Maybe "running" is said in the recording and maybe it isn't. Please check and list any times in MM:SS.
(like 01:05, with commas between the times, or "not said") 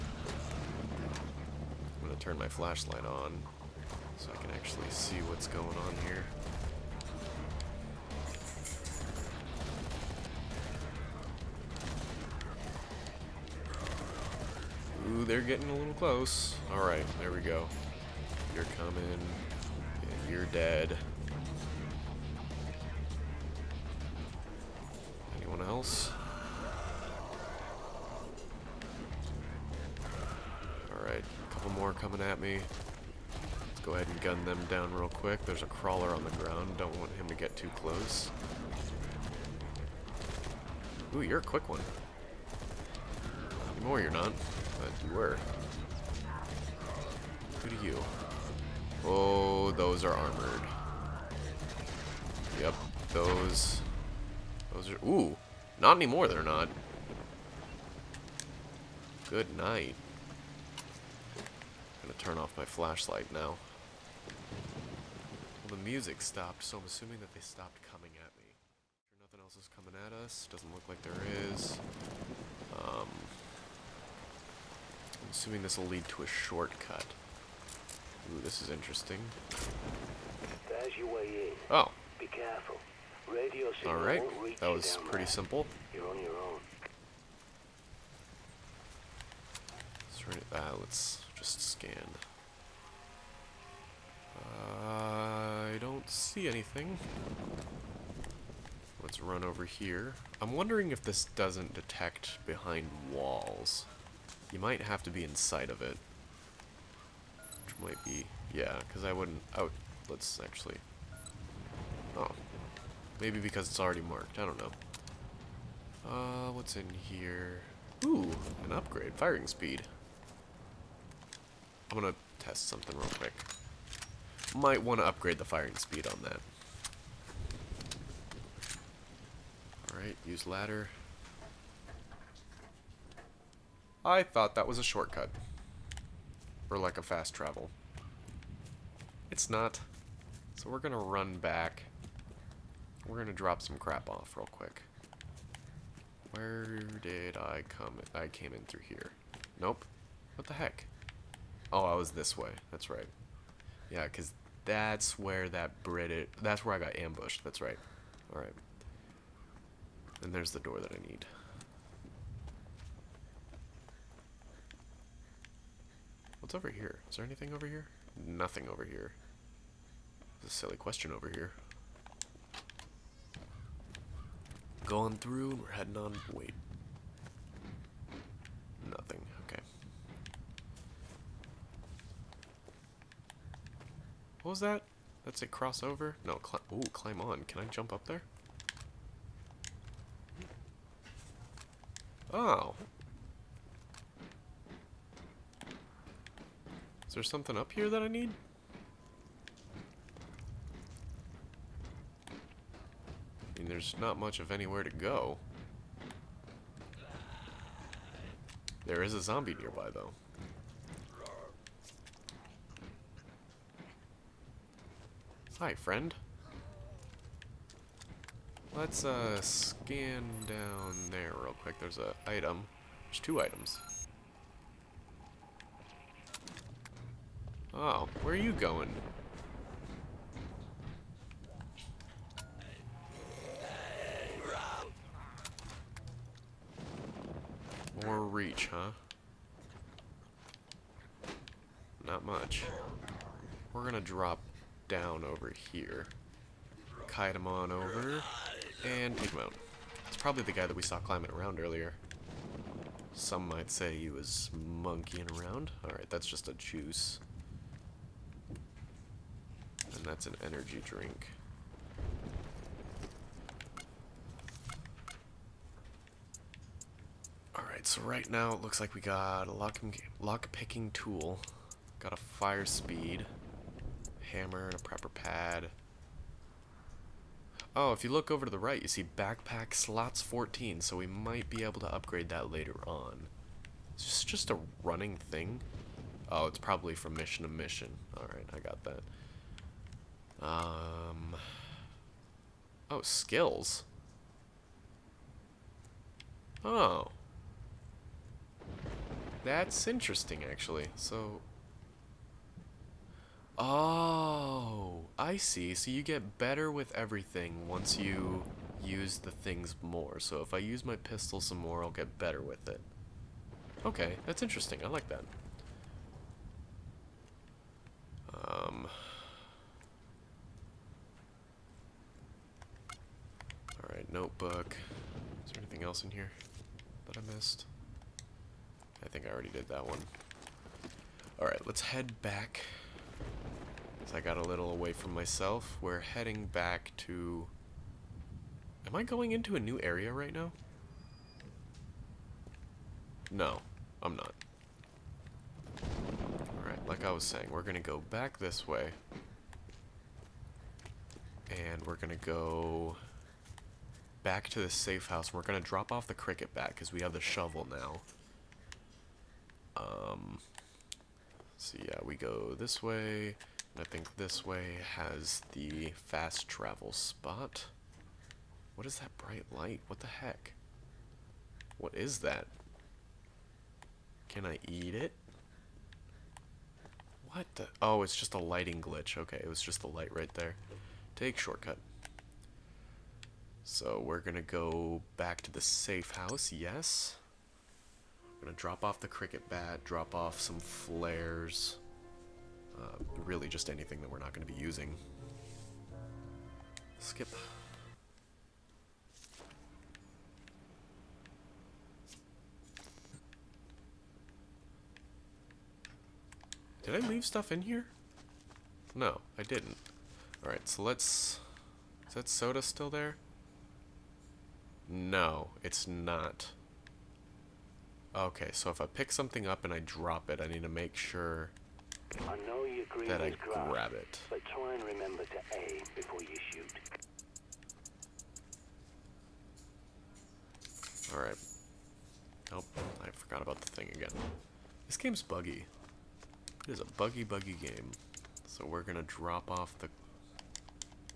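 04:44.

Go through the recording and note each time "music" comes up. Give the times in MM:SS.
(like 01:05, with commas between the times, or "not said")
01:05.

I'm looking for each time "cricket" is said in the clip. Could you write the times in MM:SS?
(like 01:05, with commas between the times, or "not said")
05:56, 06:29.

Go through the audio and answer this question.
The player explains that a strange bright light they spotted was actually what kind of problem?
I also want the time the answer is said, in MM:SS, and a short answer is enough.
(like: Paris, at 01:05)
Lighting glitch, at 06:18.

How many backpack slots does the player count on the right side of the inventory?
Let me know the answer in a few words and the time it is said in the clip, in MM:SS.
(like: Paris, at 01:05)
14, at 04:40.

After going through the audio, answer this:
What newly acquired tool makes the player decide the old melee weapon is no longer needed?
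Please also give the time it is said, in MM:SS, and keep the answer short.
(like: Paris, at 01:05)
Shovel, at 05:57.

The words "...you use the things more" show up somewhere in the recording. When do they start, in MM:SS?
05:07.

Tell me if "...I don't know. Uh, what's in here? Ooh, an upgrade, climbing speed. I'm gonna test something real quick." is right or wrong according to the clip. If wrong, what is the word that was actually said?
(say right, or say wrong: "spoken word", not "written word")
wrong: "firing", not "climbing".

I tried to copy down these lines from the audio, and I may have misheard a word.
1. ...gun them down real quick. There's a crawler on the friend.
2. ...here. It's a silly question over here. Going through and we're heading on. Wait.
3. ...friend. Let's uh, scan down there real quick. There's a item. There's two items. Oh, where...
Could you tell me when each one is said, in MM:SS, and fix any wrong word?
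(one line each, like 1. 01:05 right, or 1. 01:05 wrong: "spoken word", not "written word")
1. 00:34 wrong: "ground", not "friend"
2. 02:48 right
3. 03:35 right.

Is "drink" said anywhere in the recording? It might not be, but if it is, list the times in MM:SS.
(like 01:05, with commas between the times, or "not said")
04:20.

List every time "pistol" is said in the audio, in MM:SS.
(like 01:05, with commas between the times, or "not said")
05:10.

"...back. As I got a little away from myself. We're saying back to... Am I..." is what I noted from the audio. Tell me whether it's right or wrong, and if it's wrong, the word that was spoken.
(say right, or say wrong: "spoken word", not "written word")
wrong: "heading", not "saying".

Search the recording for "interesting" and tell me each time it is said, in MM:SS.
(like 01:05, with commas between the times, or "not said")
01:18, 04:59, 05:14.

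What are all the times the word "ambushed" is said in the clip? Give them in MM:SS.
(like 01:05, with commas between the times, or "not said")
02:36.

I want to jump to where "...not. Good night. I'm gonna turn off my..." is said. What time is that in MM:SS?
00:56.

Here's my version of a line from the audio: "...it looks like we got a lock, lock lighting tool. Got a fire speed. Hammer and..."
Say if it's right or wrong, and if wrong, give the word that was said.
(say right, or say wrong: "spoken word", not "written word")
wrong: "picking", not "lighting".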